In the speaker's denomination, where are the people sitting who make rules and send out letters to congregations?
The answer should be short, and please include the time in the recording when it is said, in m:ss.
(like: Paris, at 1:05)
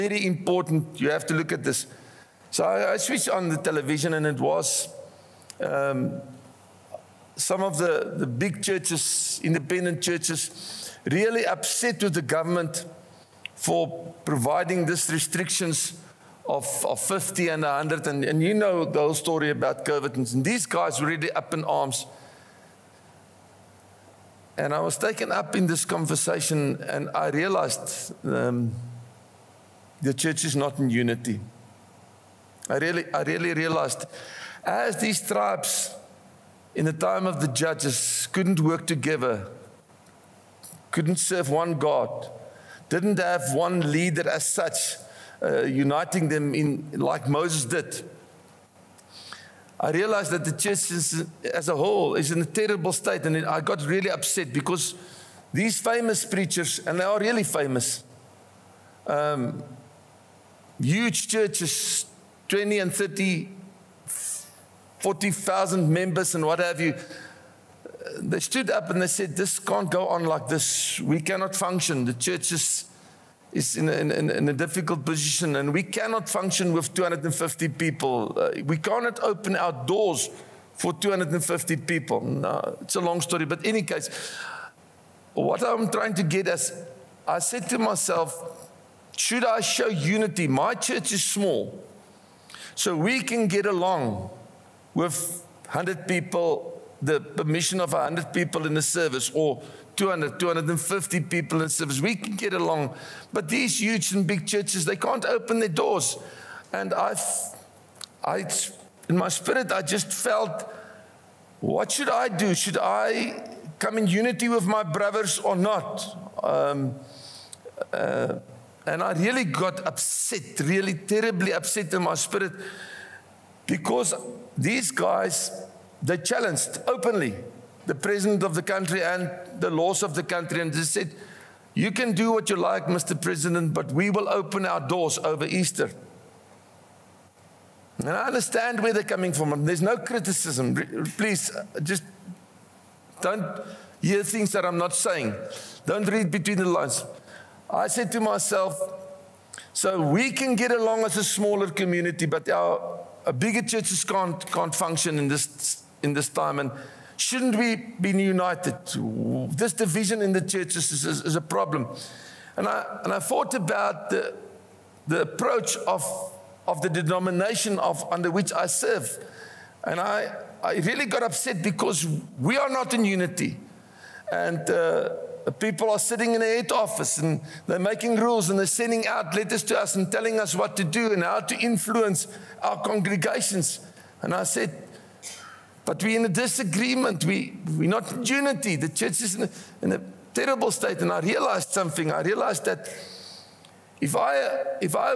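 head office, at 2:56.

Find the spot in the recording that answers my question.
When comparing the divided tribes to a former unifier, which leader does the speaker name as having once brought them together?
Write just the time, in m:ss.
0:47.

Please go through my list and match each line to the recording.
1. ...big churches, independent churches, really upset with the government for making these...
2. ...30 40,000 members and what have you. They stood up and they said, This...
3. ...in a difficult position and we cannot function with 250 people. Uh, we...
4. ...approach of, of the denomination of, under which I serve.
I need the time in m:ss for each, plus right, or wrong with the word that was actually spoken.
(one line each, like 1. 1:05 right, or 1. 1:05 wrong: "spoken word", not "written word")
1. 0:08 wrong: "providing", not "making"
2. 1:02 right
3. 1:14 right
4. 2:45 right.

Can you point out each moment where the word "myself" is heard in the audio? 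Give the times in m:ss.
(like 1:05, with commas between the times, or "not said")
1:27, 2:28.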